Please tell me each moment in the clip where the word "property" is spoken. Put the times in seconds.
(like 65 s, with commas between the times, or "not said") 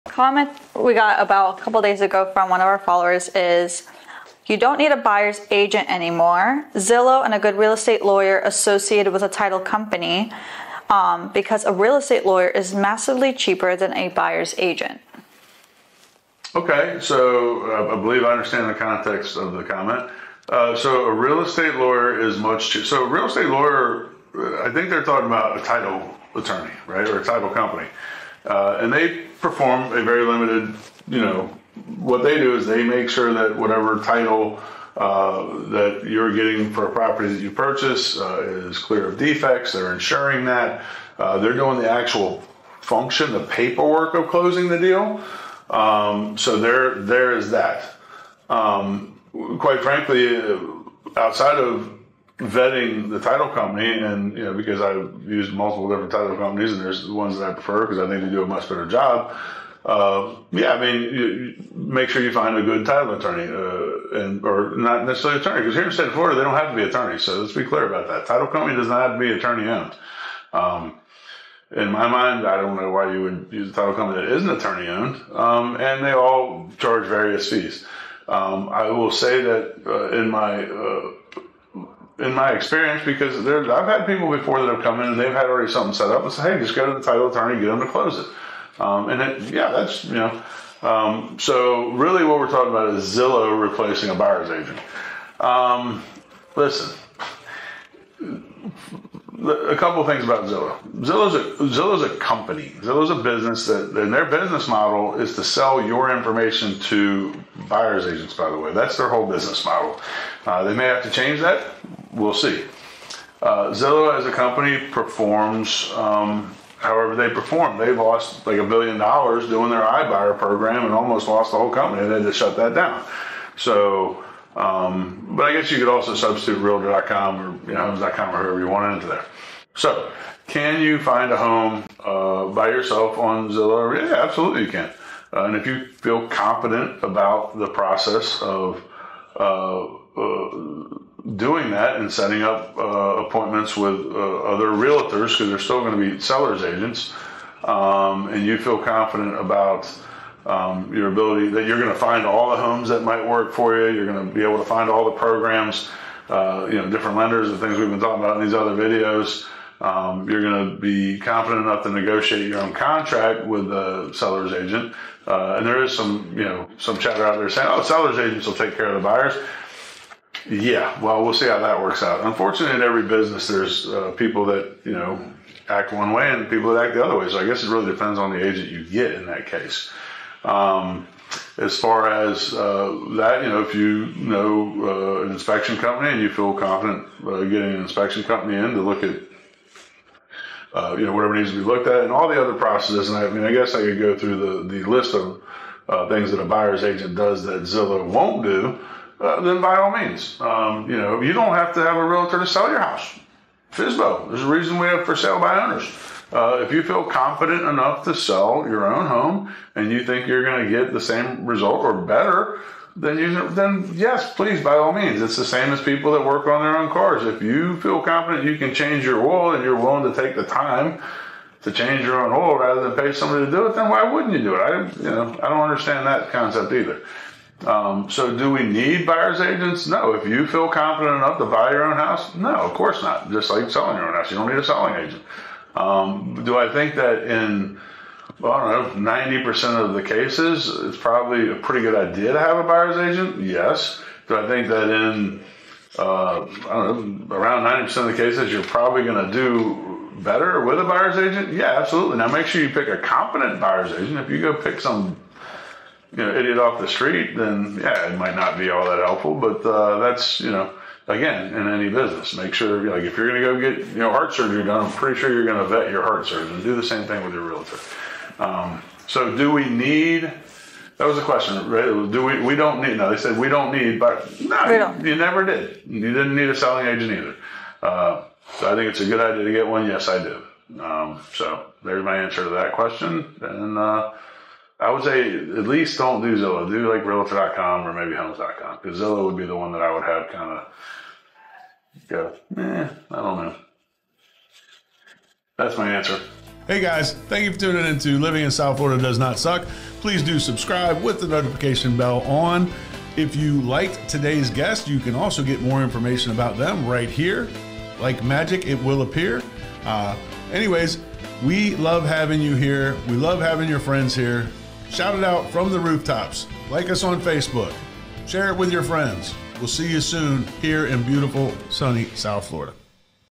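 36 s.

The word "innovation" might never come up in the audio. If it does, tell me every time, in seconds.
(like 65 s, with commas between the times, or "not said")
not said.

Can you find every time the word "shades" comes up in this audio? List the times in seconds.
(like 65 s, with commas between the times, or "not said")
not said.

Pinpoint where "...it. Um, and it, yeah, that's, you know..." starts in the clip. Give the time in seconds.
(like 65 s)
88 s.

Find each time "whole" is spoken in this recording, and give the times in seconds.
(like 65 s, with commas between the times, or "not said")
109 s, 121 s.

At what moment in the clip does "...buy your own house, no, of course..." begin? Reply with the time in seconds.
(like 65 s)
231 s.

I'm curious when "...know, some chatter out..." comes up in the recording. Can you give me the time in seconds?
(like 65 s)
166 s.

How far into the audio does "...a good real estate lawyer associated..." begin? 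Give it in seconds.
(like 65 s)
7 s.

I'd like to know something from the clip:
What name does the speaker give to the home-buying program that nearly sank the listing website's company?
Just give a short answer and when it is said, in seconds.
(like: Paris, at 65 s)
iBuyer, at 119 s.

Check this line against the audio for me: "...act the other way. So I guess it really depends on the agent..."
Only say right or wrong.
right.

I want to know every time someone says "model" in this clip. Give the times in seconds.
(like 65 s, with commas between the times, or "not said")
104 s, 109 s.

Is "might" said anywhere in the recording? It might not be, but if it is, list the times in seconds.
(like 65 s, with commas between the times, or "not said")
153 s, 258 s.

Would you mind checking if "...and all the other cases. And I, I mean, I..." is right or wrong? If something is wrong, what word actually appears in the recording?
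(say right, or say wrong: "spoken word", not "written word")
wrong: "processes", not "cases".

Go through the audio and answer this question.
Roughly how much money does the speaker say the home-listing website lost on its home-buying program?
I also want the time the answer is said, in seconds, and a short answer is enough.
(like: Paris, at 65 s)
a billion dollars, at 118 s.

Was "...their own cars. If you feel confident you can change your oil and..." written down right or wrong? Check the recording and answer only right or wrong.
right.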